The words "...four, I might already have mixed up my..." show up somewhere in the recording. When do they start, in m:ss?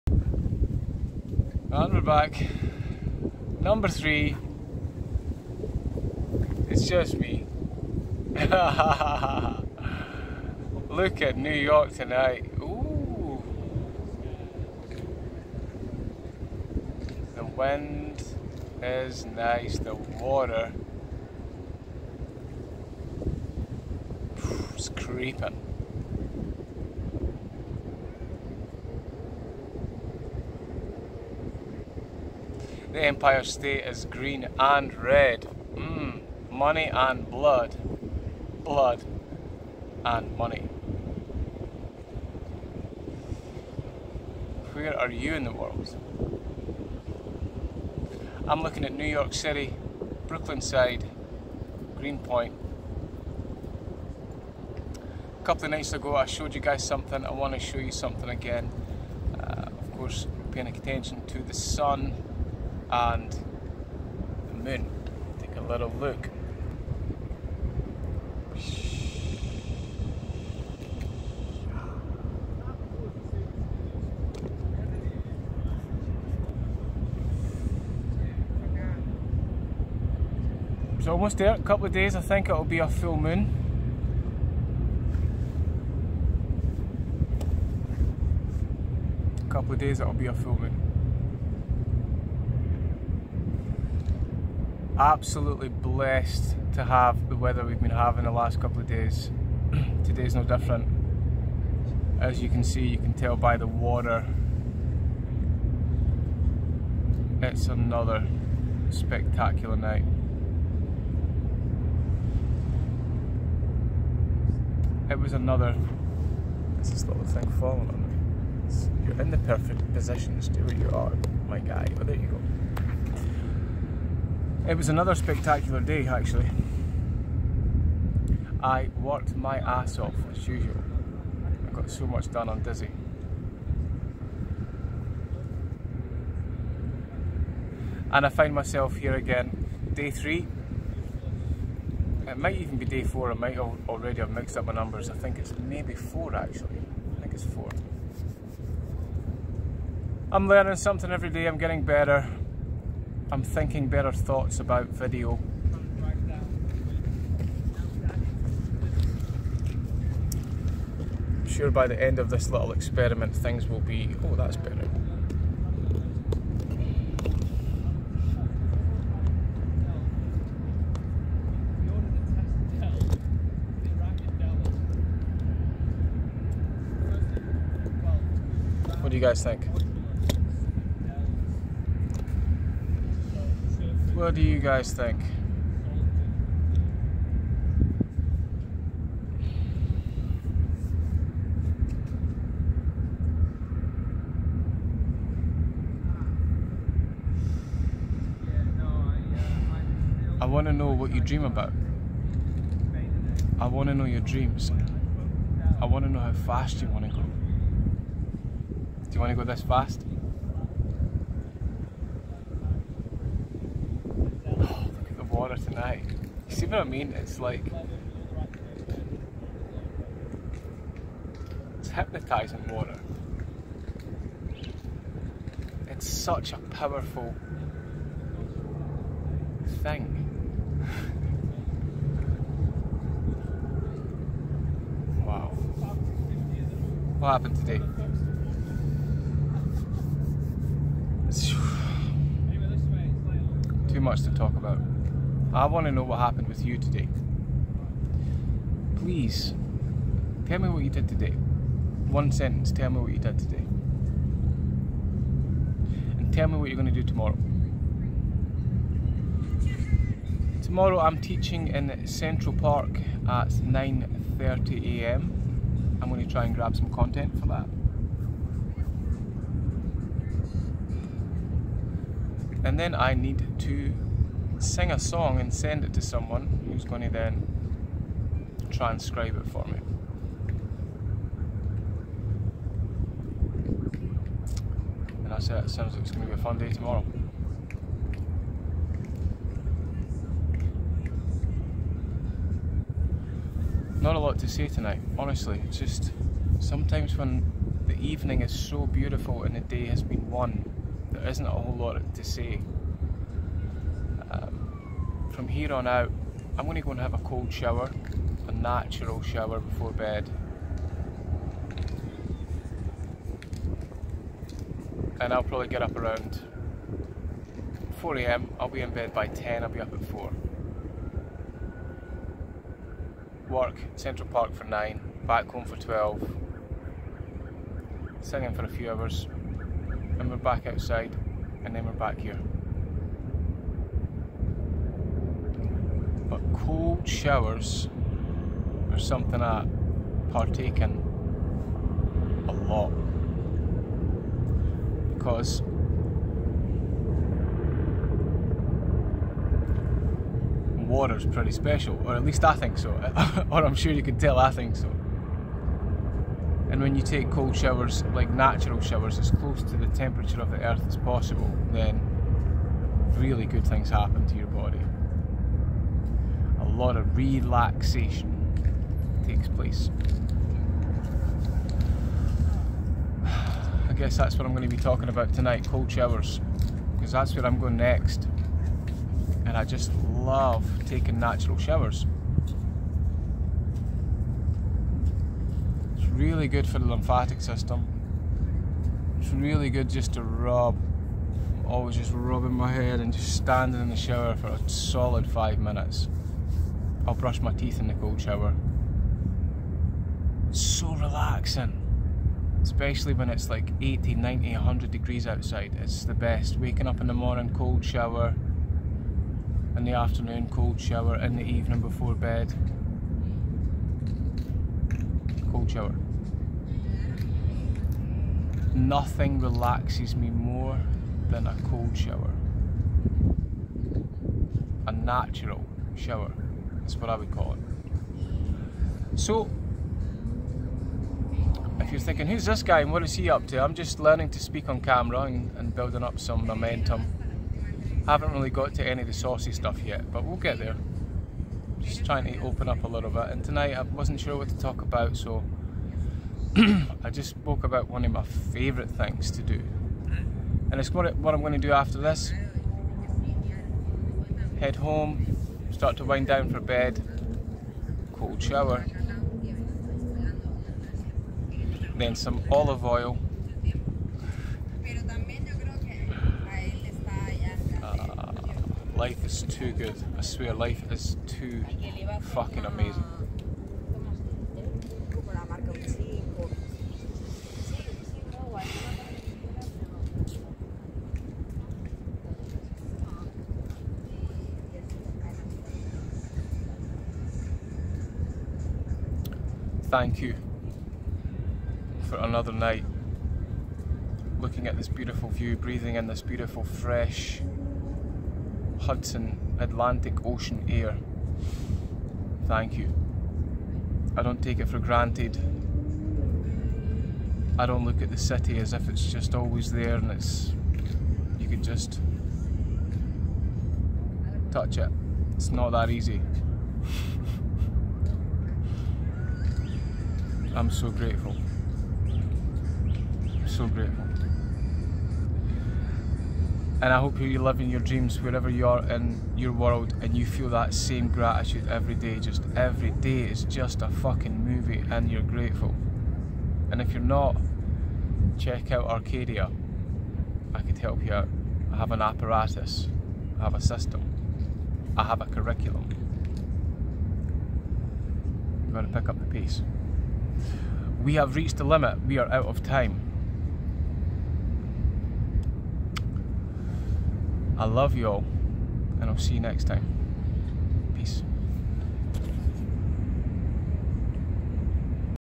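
2:23.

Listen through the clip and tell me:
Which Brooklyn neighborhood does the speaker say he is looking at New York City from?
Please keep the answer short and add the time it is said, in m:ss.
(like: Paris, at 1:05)
Greenpoint, at 0:51.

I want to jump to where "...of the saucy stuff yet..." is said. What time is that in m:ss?
7:19.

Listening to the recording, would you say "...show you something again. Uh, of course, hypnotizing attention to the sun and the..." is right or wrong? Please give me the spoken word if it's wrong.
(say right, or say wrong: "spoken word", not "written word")
wrong: "paying", not "hypnotizing".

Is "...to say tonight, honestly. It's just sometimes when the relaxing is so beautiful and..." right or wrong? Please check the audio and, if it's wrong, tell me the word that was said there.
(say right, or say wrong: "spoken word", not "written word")
wrong: "evening", not "relaxing".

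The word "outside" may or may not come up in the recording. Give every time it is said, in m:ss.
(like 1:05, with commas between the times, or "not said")
5:30, 6:45.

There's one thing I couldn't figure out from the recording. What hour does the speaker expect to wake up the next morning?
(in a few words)
4 am.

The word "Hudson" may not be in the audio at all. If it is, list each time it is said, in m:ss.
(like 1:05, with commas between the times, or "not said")
8:18.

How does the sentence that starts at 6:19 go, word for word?
And I just love taking natural showers.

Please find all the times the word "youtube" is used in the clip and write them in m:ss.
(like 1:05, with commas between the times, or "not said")
not said.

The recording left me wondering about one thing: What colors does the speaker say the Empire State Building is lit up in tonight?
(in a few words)
green and red.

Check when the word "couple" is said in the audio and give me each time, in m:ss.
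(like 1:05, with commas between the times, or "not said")
0:55, 1:21, 1:29, 1:38.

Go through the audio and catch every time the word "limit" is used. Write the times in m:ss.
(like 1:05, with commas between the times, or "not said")
9:11.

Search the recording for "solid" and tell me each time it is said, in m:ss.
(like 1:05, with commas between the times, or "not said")
6:34.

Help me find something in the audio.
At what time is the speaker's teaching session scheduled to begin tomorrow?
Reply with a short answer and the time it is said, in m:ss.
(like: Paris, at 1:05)
9:30 am, at 4:23.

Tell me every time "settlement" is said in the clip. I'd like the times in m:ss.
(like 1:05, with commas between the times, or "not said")
not said.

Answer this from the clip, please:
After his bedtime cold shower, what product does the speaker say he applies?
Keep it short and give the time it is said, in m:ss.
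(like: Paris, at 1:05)
olive oil, at 7:42.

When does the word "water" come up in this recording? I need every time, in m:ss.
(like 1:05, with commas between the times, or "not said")
0:19, 1:43, 3:42, 5:50.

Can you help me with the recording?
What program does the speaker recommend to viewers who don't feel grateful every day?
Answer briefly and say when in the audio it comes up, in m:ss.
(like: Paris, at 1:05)
Arcadia, at 8:58.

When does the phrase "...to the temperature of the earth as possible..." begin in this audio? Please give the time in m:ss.
5:59.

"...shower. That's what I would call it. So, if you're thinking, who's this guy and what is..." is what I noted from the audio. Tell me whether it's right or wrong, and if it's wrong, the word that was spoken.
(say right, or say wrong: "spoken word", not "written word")
right.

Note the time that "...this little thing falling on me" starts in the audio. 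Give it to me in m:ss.
1:56.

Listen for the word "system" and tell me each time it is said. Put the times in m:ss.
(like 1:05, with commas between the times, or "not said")
6:27, 9:03.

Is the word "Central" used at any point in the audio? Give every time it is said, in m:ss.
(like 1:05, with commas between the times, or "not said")
4:22, 5:23.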